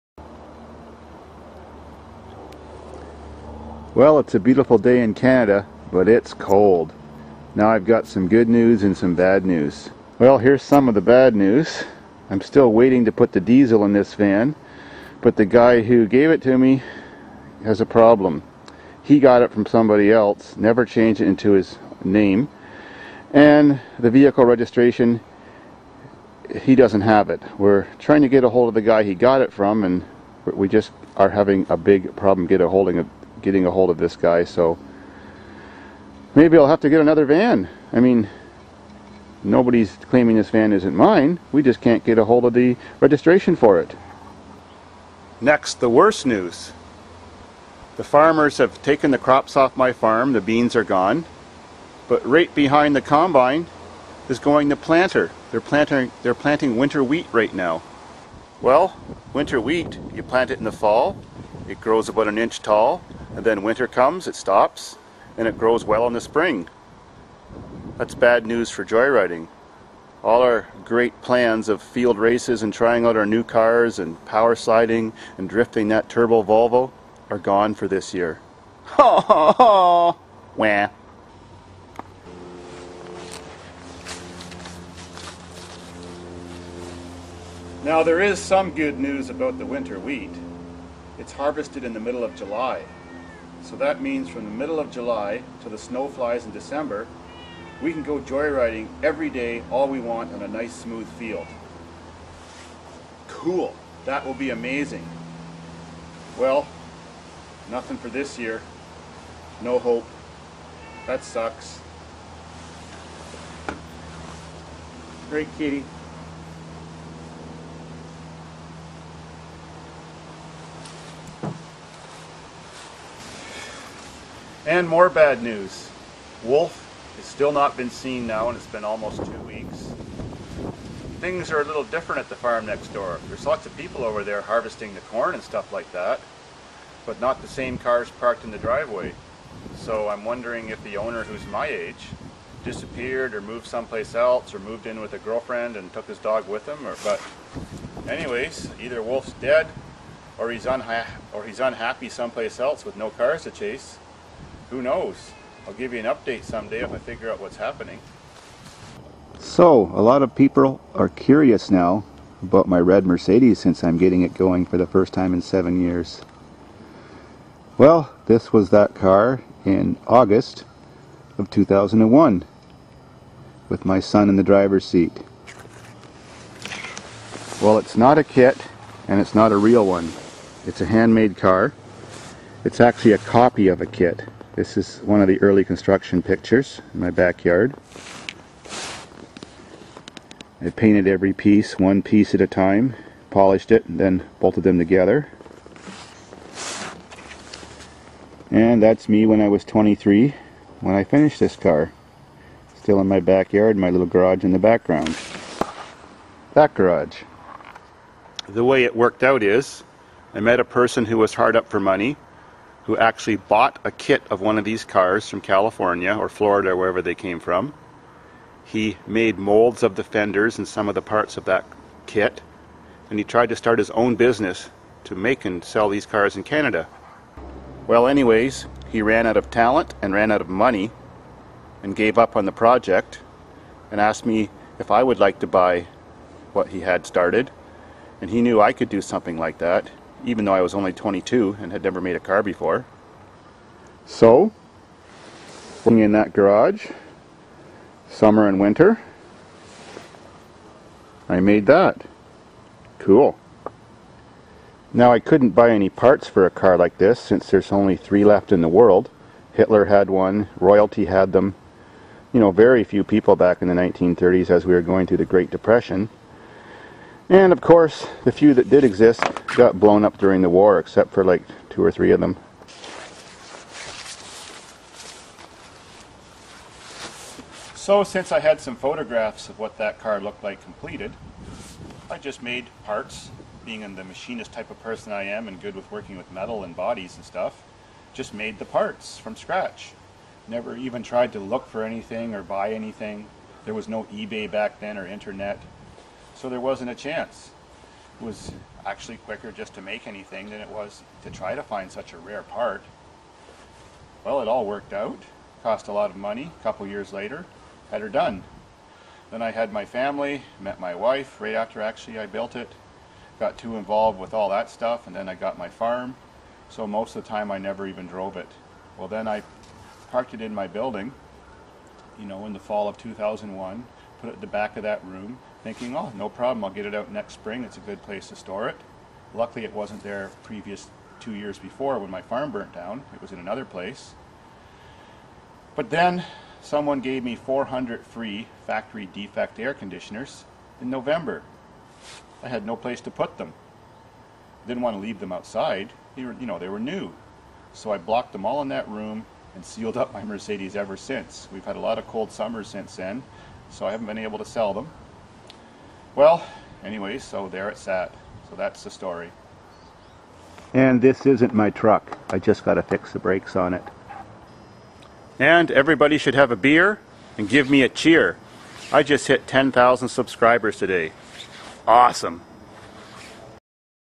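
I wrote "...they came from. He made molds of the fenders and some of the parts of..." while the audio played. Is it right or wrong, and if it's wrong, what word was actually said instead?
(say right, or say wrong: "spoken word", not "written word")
right.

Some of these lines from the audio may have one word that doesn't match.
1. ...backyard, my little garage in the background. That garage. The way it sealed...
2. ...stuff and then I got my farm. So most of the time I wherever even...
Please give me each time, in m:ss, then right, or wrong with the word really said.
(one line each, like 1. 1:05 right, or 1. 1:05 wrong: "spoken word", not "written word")
1. 3:23 wrong: "worked", not "sealed"
2. 5:14 wrong: "never", not "wherever".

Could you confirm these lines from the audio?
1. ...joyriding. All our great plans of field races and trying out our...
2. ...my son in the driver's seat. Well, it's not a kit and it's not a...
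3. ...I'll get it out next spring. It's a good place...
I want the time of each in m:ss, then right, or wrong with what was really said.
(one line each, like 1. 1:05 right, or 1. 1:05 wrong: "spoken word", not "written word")
1. 1:08 right
2. 2:53 right
3. 5:26 right.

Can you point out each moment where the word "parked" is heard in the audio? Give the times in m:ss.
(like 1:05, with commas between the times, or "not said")
2:18, 5:20.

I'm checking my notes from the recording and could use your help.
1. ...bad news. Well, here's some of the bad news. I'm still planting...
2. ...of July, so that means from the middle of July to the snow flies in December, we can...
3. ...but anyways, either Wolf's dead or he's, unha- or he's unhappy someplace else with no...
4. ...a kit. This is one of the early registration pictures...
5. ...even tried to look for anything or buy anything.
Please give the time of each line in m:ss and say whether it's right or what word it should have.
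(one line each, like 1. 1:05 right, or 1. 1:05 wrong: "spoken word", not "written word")
1. 0:09 wrong: "waiting", not "planting"
2. 1:32 right
3. 2:27 right
4. 3:03 wrong: "construction", not "registration"
5. 4:50 right.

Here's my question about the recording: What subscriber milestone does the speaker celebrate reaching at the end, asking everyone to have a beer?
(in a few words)
10,000 subscribers.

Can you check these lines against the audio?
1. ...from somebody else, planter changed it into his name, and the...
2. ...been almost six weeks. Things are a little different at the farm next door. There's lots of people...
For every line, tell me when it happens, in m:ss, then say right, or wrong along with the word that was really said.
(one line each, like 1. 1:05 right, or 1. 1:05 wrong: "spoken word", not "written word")
1. 0:19 wrong: "never", not "planter"
2. 2:08 wrong: "two", not "six".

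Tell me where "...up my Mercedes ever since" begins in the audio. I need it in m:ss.
5:49.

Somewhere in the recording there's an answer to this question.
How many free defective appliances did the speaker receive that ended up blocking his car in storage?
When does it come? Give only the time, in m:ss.
5:37.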